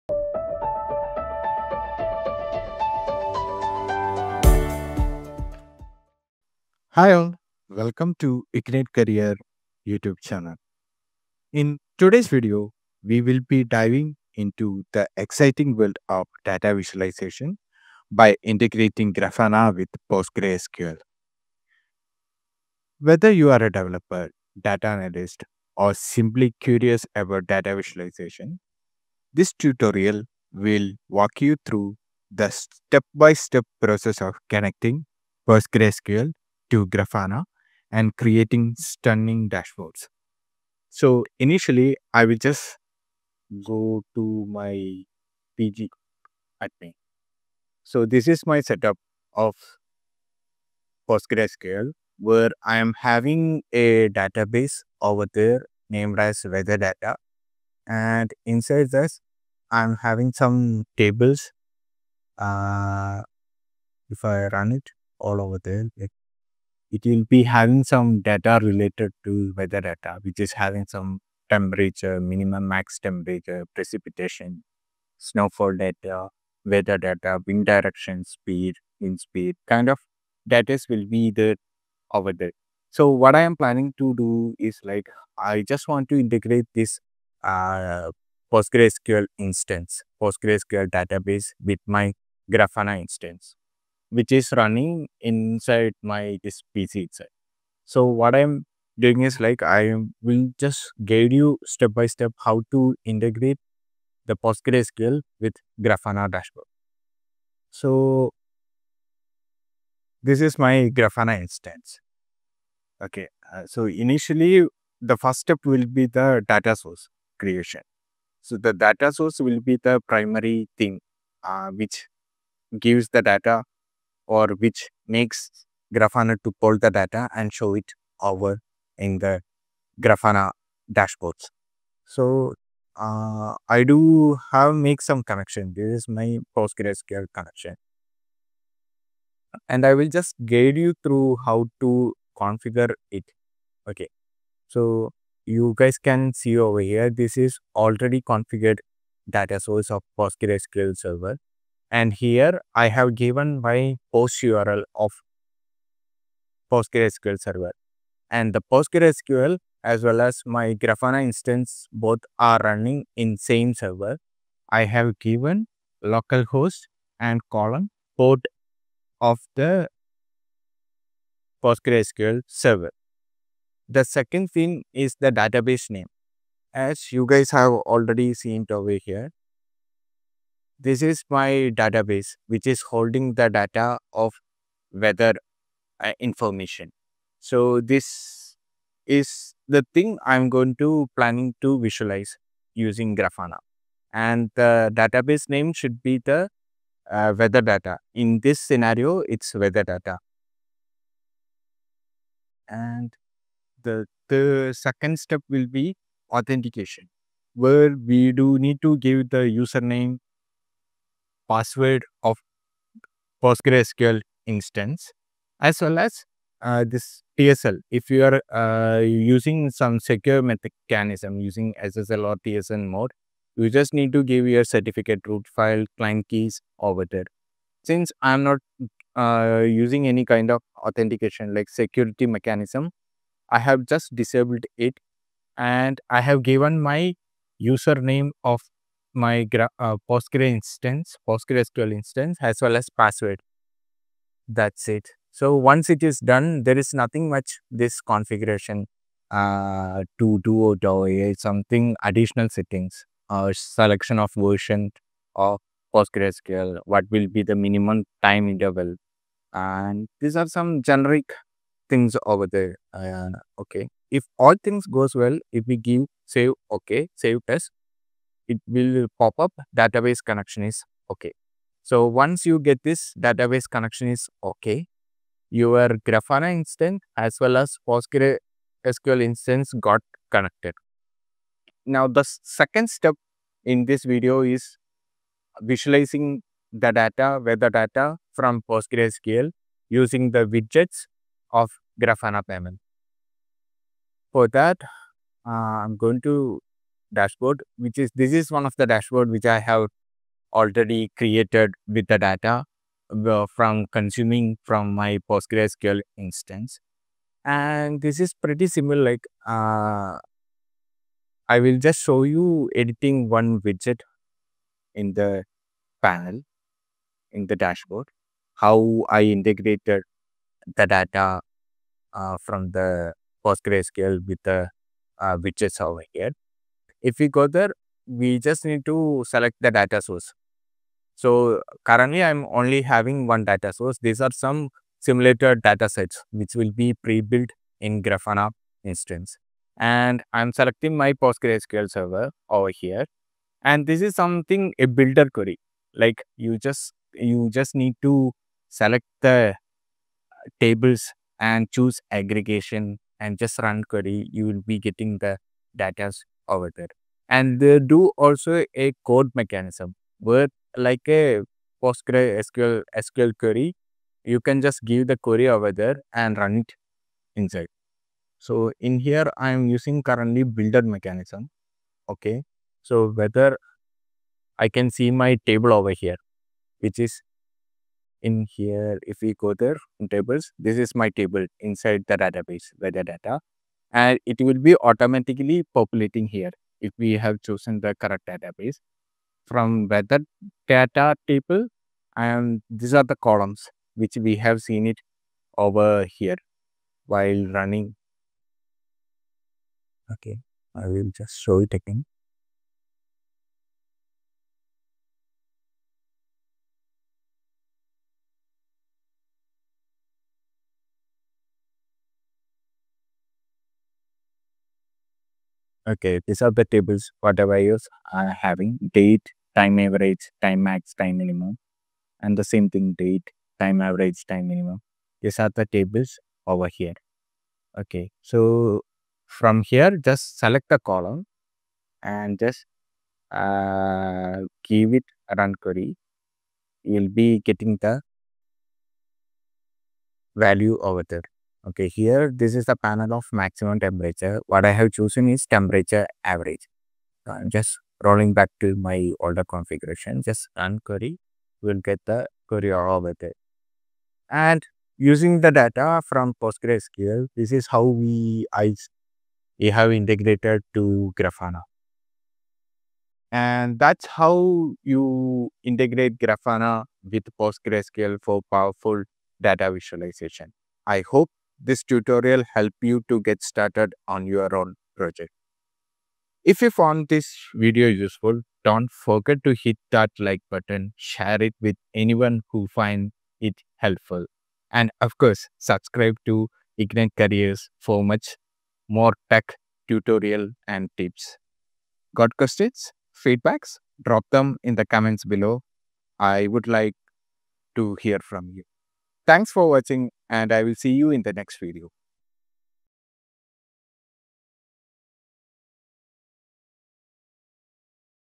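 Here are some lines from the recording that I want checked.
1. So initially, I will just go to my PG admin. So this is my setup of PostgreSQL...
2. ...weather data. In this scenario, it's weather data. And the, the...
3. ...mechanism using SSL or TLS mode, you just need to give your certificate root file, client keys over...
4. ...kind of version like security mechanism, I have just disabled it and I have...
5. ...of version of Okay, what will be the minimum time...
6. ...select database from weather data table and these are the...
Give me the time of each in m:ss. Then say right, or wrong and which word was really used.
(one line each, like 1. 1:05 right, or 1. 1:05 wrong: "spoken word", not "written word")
1. 0:40 right
2. 3:17 right
3. 3:40 right
4. 3:50 wrong: "authentication", not "version"
5. 4:14 wrong: "PostgreSQL", not "Okay"
6. 6:27 wrong: "correct", not "select".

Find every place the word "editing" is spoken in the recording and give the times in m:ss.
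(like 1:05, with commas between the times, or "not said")
5:12.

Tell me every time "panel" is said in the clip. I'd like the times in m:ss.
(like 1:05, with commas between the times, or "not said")
5:16, 7:22.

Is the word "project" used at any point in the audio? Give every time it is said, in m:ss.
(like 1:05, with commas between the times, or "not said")
7:54.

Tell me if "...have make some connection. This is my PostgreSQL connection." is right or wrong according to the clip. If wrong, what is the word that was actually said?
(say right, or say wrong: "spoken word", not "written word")
right.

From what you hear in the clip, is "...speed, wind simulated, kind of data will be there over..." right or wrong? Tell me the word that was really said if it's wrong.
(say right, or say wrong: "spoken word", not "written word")
wrong: "speed", not "simulated".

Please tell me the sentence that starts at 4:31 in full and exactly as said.
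So once you get this database connection is okay, your Grafana instance as well as PostgreSQL instance got connected.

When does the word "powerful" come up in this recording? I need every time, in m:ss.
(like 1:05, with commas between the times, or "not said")
7:48.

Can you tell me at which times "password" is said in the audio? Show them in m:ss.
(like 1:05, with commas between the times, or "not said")
3:31, 4:02.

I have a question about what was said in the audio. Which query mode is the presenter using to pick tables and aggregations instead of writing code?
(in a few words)
builder mechanism.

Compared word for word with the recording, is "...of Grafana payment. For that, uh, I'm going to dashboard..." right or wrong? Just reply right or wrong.
right.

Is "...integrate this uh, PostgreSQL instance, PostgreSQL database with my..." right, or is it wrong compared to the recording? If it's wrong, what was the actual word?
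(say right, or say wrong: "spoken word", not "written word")
right.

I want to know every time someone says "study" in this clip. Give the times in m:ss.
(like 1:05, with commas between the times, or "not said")
not said.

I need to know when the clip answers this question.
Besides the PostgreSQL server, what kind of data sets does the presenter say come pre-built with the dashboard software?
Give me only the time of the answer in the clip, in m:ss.
5:34.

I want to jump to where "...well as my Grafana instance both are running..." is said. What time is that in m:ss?
2:40.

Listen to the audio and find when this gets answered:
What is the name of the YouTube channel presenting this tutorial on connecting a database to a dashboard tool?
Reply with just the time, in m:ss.
0:08.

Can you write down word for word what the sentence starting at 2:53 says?
The second thing is the database name.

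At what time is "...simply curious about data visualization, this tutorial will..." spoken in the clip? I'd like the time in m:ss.
0:25.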